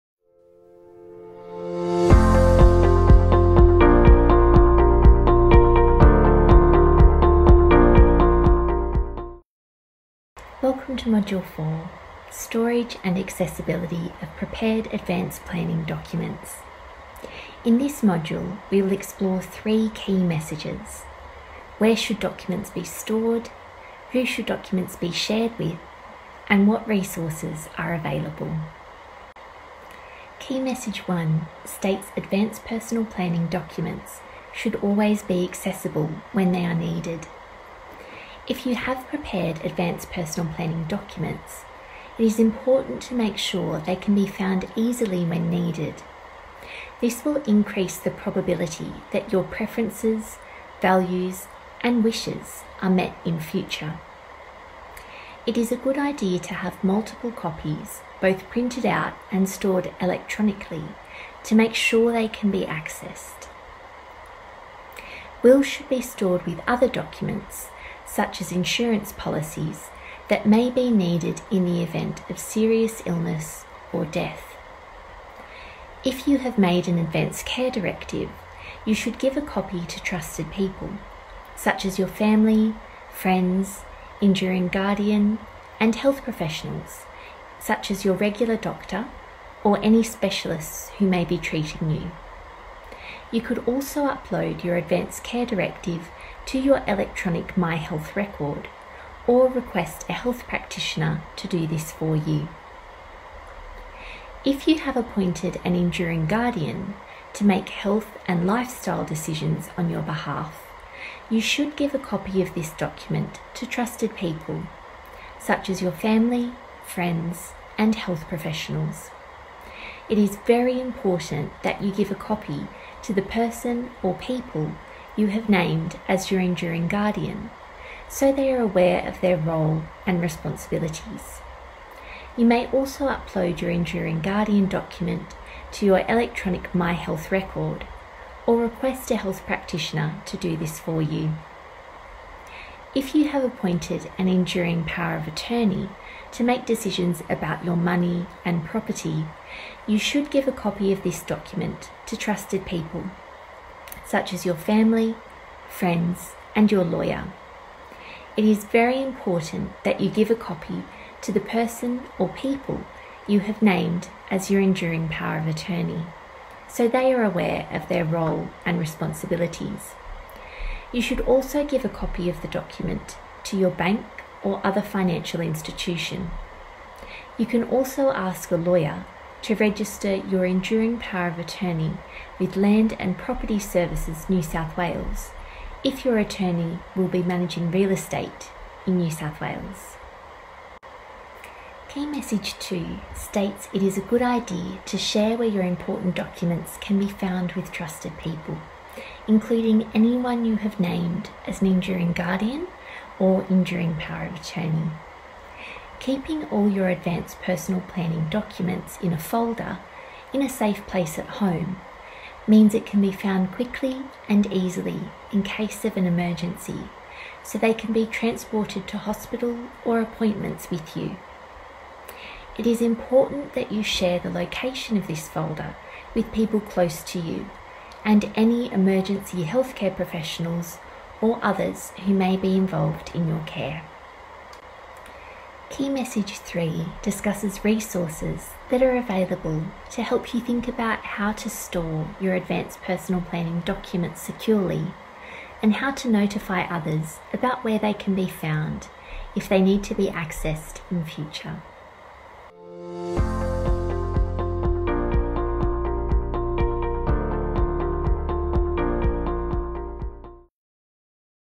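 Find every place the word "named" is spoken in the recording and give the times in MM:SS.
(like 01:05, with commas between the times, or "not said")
02:05, 02:43, 03:20.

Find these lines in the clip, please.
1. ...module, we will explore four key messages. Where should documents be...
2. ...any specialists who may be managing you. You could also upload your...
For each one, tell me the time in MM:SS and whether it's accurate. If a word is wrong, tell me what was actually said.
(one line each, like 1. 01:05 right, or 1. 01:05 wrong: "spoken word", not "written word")
1. 00:18 wrong: "three", not "four"
2. 01:29 wrong: "treating", not "managing".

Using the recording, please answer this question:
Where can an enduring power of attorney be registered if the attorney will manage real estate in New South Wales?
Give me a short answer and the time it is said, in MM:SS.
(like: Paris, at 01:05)
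Land and Property Services New South Wales, at 03:02.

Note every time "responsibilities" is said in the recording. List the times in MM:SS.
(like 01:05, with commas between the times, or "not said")
02:10, 02:48.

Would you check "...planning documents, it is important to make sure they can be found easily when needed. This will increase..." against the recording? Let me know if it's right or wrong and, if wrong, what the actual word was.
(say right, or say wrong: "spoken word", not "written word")
right.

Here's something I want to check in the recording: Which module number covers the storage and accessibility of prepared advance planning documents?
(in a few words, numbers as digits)
4.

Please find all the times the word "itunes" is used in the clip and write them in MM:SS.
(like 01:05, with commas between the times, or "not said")
not said.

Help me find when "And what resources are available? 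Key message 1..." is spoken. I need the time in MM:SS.
00:26.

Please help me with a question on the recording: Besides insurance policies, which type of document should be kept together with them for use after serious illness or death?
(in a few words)
Wills.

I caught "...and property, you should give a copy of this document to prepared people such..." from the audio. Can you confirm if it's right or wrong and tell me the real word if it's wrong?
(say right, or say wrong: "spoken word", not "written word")
wrong: "trusted", not "prepared".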